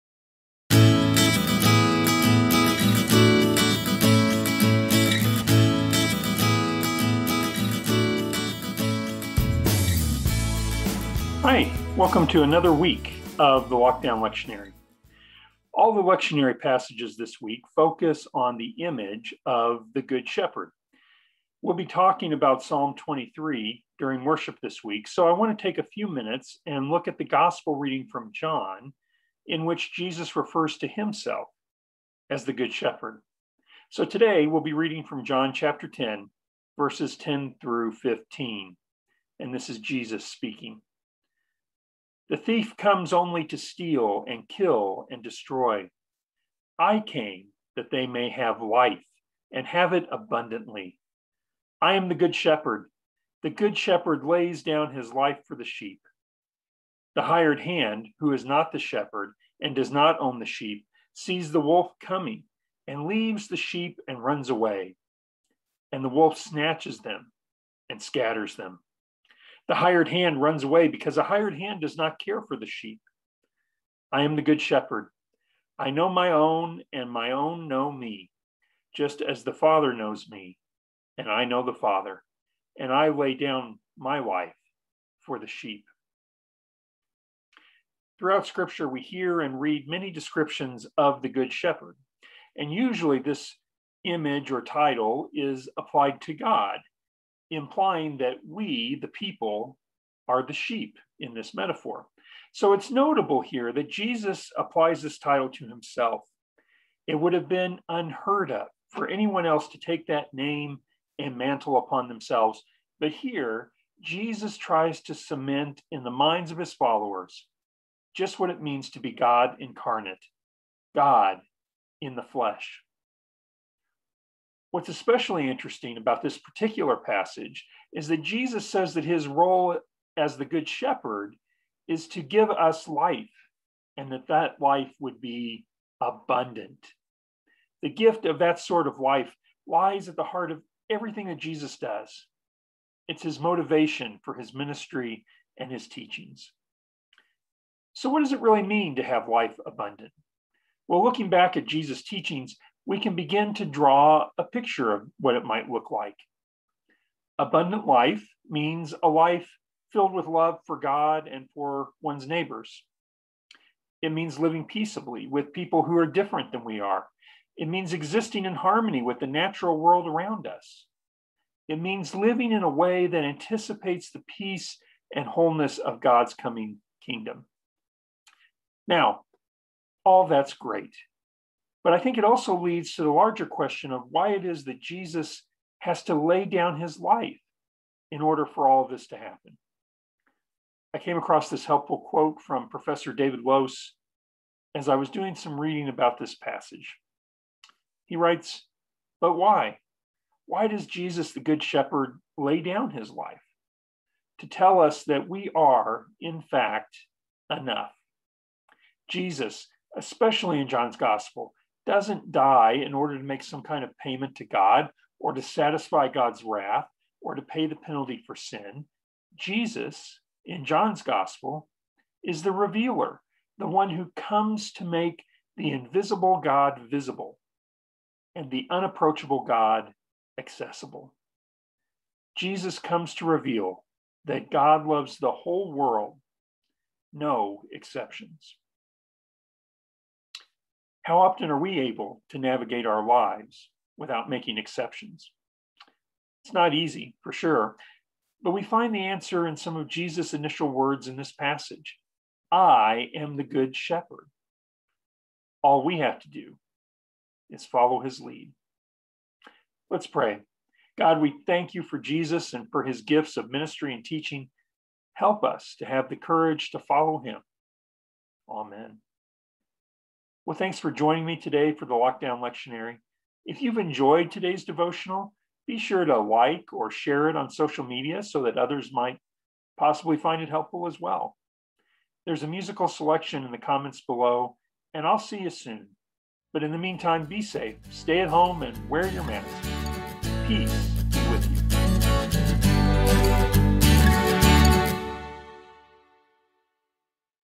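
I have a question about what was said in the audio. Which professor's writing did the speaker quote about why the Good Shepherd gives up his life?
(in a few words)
David Lose.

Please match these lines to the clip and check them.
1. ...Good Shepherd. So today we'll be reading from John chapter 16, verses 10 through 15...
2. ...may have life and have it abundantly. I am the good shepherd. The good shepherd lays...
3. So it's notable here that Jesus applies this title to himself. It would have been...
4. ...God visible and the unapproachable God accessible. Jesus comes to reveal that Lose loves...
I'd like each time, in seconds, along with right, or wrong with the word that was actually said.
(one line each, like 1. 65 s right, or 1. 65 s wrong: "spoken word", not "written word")
1. 32 s wrong: "10", not "16"
2. 48 s right
3. 102 s right
4. 226 s wrong: "God", not "Lose".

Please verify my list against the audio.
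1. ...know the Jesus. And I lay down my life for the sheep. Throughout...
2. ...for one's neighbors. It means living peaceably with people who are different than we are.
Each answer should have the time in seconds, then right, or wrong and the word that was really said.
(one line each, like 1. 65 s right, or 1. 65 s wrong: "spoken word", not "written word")
1. 81 s wrong: "Father", not "Jesus"
2. 161 s right.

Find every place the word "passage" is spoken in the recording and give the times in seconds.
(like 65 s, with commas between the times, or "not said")
16 s, 126 s, 196 s, 251 s.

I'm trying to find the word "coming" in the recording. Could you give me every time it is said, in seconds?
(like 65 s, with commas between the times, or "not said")
61 s, 176 s.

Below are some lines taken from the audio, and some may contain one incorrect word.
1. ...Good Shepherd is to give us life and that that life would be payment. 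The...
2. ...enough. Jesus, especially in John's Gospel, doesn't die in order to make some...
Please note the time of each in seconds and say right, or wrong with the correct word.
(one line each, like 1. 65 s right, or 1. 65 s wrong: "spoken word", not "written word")
1. 130 s wrong: "abundant", not "payment"
2. 207 s right.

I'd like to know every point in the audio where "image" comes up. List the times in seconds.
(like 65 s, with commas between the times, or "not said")
18 s, 94 s.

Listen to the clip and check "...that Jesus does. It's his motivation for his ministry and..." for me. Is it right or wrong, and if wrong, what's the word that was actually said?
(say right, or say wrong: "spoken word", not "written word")
right.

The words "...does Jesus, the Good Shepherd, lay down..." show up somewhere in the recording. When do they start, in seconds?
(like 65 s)
200 s.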